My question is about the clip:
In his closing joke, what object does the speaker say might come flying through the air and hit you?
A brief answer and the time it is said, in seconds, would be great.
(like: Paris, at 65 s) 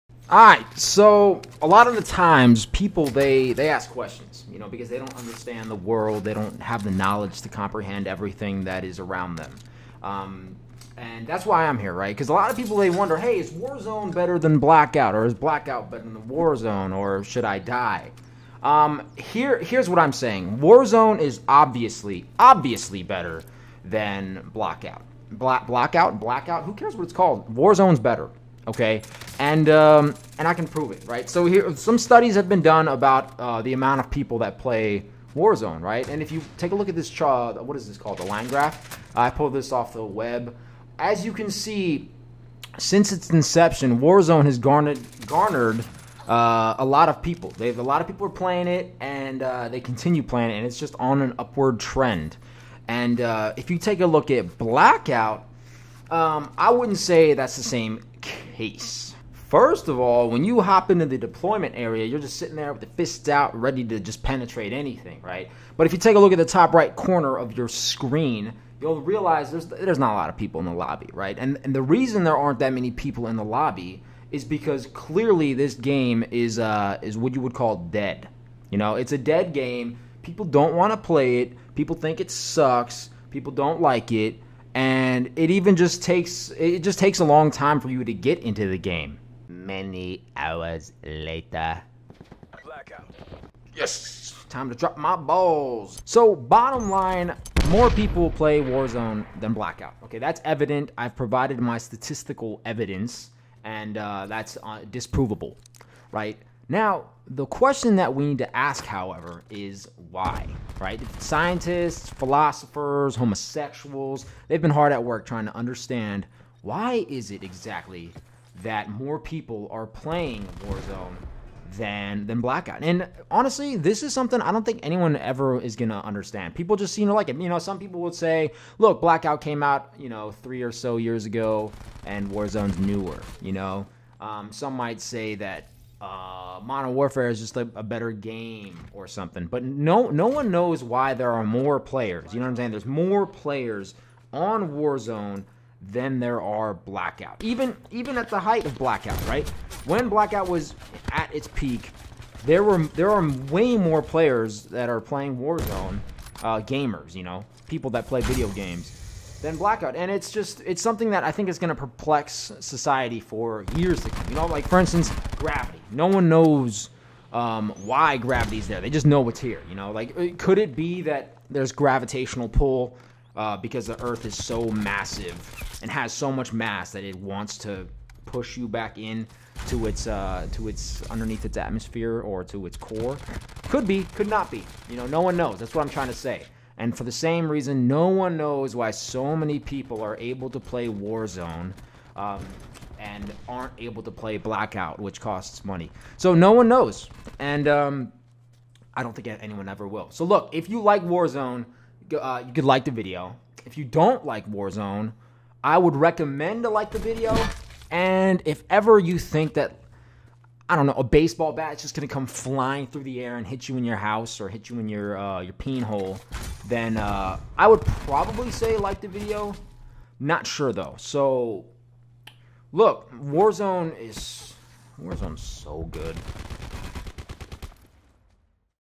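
Baseball bat, at 211 s.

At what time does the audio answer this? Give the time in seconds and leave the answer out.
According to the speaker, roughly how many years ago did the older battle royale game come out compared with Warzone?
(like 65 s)
130 s.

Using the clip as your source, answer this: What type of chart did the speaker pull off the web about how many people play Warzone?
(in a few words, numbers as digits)
Line graph.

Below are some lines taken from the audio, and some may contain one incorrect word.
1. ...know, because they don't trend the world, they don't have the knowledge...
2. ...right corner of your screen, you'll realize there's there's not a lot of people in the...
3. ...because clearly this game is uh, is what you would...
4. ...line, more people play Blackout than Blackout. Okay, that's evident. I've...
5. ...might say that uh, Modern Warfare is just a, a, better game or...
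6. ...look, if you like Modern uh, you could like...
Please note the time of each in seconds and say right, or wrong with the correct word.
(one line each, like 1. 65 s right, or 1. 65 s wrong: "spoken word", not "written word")
1. 4 s wrong: "understand", not "trend"
2. 66 s right
3. 74 s right
4. 96 s wrong: "Warzone", not "Blackout"
5. 134 s right
6. 200 s wrong: "Warzone", not "Modern".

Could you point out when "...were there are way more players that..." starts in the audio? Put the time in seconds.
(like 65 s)
152 s.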